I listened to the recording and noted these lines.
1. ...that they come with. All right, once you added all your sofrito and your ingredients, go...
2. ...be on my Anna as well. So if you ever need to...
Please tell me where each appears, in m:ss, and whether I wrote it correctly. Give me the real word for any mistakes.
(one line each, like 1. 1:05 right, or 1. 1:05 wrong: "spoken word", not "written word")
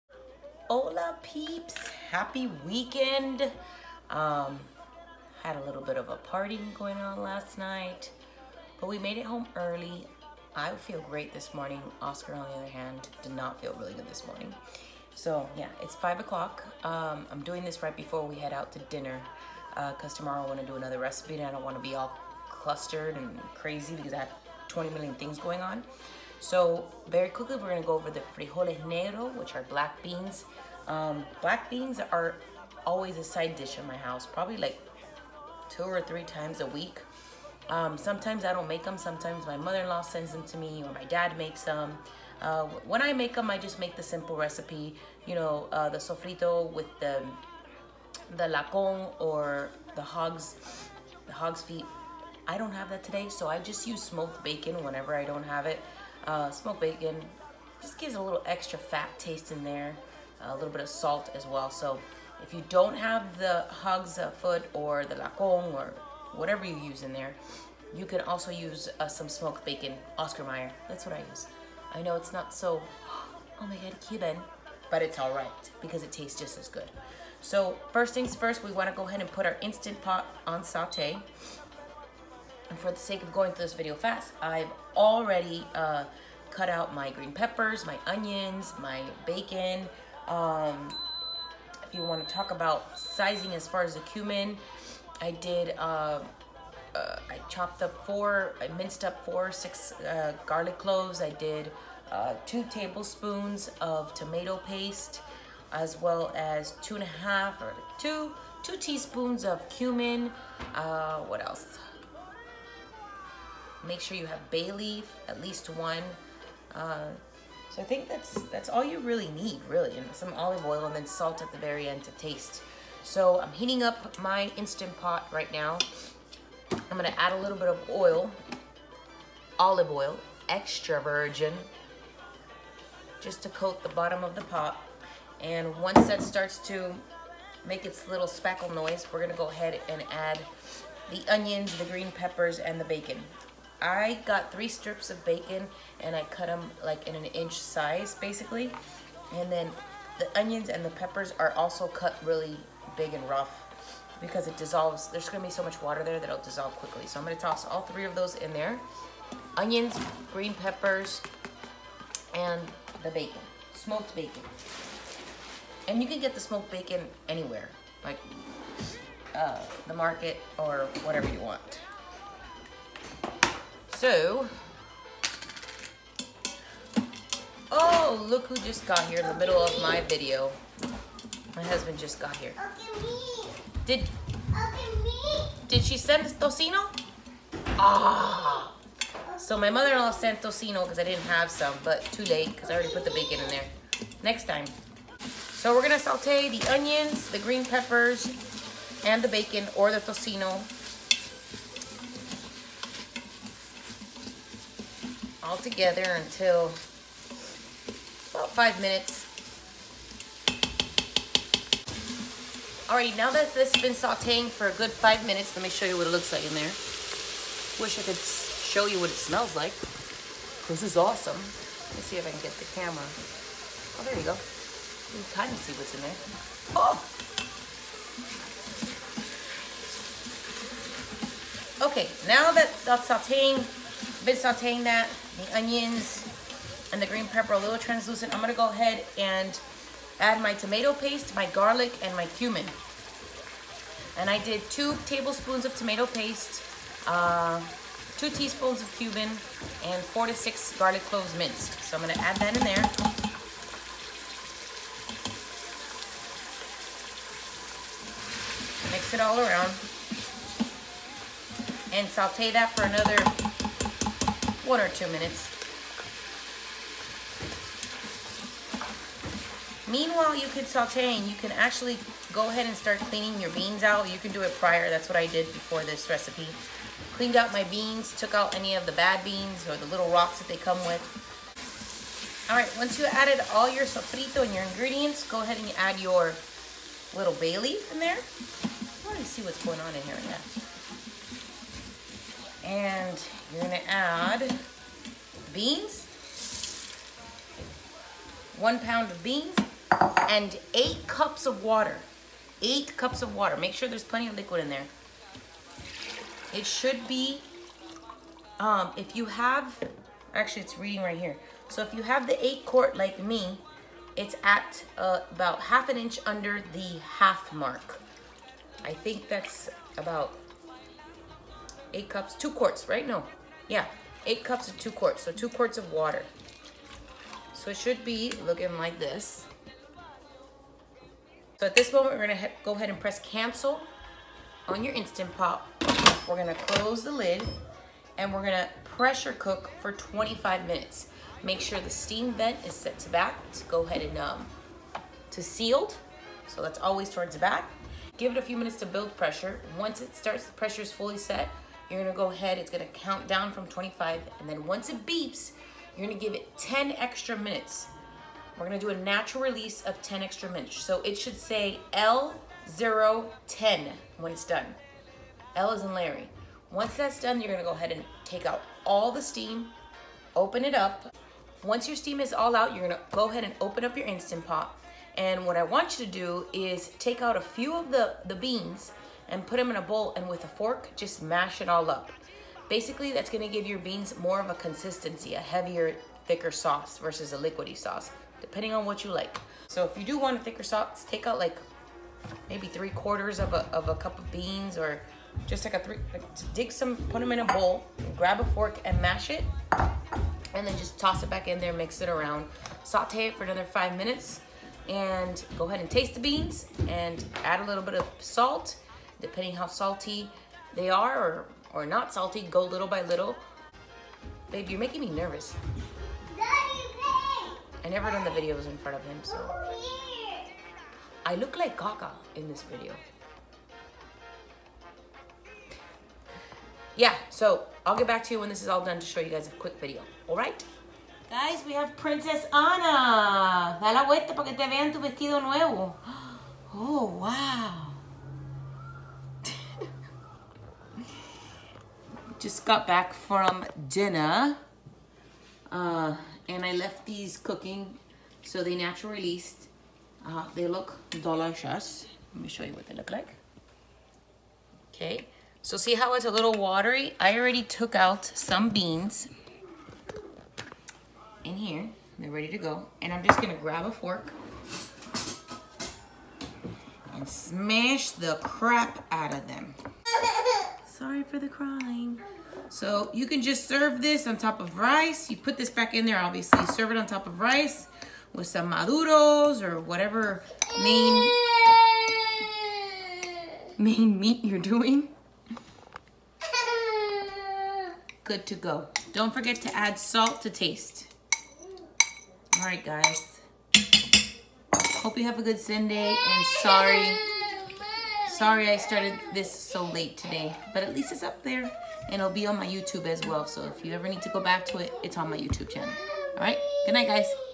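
1. 4:40 right
2. 8:22 wrong: "YouTube", not "Anna".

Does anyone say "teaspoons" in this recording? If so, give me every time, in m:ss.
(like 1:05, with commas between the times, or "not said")
1:48, 4:08.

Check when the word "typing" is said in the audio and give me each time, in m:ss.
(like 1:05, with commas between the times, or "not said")
not said.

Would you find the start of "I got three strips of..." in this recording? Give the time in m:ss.
2:23.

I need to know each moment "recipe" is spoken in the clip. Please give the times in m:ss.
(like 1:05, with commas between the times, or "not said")
0:20, 0:44, 4:36.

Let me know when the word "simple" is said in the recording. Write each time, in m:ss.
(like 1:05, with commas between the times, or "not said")
0:44.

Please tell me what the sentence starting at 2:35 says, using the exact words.
There's gonna be so much water there that it'll dissolve quickly.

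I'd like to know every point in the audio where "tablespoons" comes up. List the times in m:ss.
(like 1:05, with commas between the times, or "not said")
1:42, 4:05.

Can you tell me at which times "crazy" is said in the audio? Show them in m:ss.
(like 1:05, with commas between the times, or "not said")
0:23.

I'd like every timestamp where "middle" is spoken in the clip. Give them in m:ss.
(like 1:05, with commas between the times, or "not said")
2:59.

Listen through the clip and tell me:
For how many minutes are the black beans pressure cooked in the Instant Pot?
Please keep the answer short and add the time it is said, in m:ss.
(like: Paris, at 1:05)
25 minutes, at 5:39.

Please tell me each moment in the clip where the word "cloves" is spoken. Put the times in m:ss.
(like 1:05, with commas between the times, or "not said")
1:40, 4:11.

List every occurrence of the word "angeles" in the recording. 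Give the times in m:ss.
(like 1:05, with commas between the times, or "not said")
not said.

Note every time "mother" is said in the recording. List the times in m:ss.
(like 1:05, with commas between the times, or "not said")
0:39, 3:09.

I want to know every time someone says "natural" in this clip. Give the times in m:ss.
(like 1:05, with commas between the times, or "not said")
5:58, 7:28.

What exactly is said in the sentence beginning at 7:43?
And I'm just going to grab a fork and smash the crap out of them.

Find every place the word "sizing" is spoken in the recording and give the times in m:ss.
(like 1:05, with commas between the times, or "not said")
1:32.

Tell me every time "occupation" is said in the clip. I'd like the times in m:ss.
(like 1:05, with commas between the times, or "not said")
not said.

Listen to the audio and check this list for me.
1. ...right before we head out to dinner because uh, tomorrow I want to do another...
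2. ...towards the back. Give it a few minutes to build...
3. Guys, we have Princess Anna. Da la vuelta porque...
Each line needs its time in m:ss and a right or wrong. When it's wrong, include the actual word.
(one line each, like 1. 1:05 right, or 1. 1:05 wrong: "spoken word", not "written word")
1. 0:17 right
2. 5:47 right
3. 7:11 right.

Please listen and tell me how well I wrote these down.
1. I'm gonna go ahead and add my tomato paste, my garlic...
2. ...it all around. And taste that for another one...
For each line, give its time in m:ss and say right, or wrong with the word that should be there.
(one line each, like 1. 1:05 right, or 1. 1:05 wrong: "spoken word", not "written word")
1. 3:58 right
2. 4:19 wrong: "saute", not "taste".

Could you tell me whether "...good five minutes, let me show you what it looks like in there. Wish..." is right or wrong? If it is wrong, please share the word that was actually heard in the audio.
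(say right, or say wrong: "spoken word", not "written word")
right.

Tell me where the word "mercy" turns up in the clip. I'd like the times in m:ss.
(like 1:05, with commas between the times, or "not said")
not said.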